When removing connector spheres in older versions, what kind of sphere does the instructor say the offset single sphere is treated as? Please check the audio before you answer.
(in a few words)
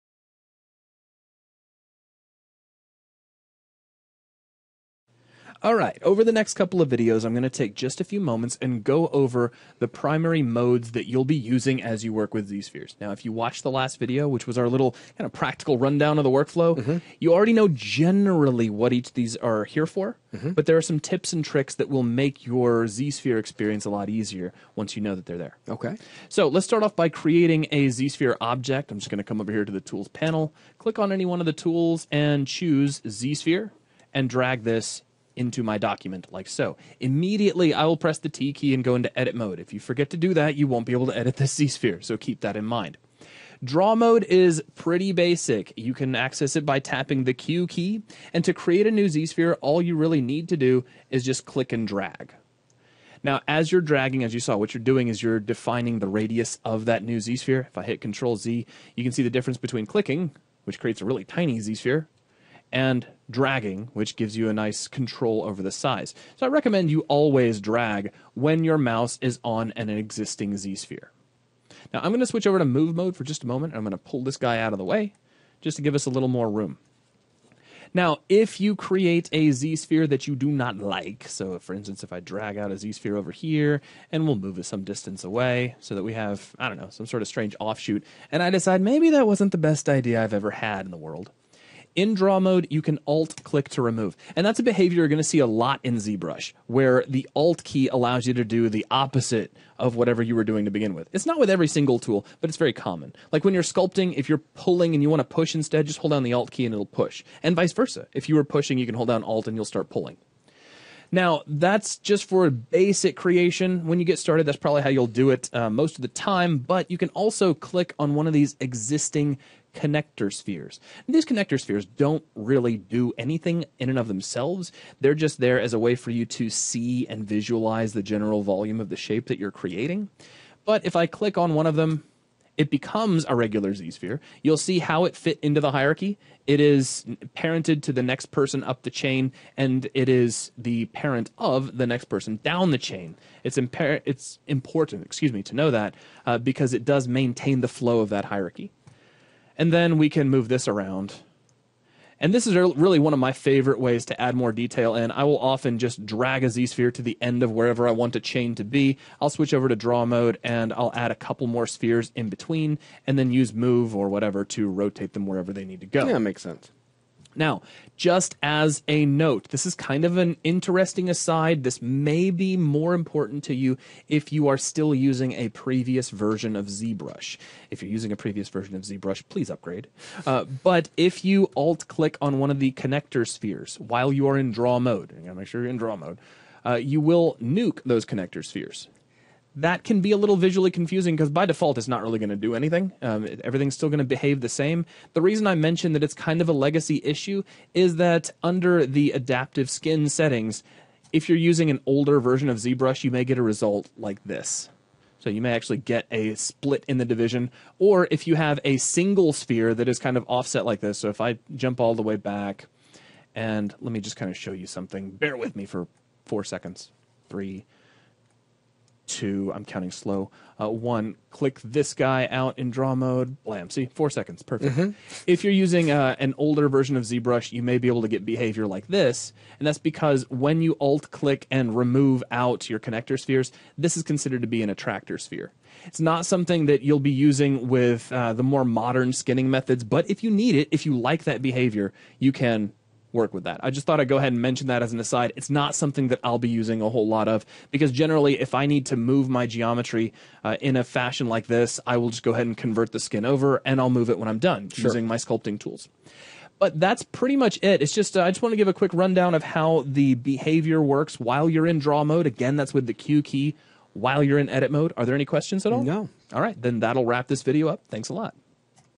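attractor sphere.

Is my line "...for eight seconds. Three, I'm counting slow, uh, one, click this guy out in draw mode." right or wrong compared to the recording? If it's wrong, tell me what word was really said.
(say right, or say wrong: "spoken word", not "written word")
wrong: "four", not "eight".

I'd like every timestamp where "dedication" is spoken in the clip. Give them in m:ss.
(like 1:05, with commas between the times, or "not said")
not said.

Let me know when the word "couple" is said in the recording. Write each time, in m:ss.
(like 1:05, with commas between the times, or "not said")
0:06, 2:41.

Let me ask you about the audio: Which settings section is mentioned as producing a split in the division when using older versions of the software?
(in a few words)
adaptive skin settings.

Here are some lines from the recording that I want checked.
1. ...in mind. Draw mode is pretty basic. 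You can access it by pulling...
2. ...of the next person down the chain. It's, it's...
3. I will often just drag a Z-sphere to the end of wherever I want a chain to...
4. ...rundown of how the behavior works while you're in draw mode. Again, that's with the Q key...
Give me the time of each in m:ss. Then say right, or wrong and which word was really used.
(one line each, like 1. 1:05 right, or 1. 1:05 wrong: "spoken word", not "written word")
1. 0:42 wrong: "tapping", not "pulling"
2. 2:21 right
3. 2:35 right
4. 4:18 right.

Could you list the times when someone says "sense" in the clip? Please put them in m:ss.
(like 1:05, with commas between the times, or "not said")
2:46.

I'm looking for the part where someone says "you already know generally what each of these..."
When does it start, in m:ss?
0:17.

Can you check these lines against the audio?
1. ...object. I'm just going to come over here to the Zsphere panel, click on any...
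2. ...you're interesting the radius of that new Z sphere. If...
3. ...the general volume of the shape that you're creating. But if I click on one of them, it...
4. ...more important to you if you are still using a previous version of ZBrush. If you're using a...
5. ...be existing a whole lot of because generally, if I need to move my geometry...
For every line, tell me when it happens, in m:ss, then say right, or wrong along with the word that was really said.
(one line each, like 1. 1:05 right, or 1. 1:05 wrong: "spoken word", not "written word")
1. 0:28 wrong: "Tools", not "Zsphere"
2. 0:55 wrong: "defining", not "interesting"
3. 2:07 right
4. 2:52 right
5. 4:06 wrong: "using", not "existing".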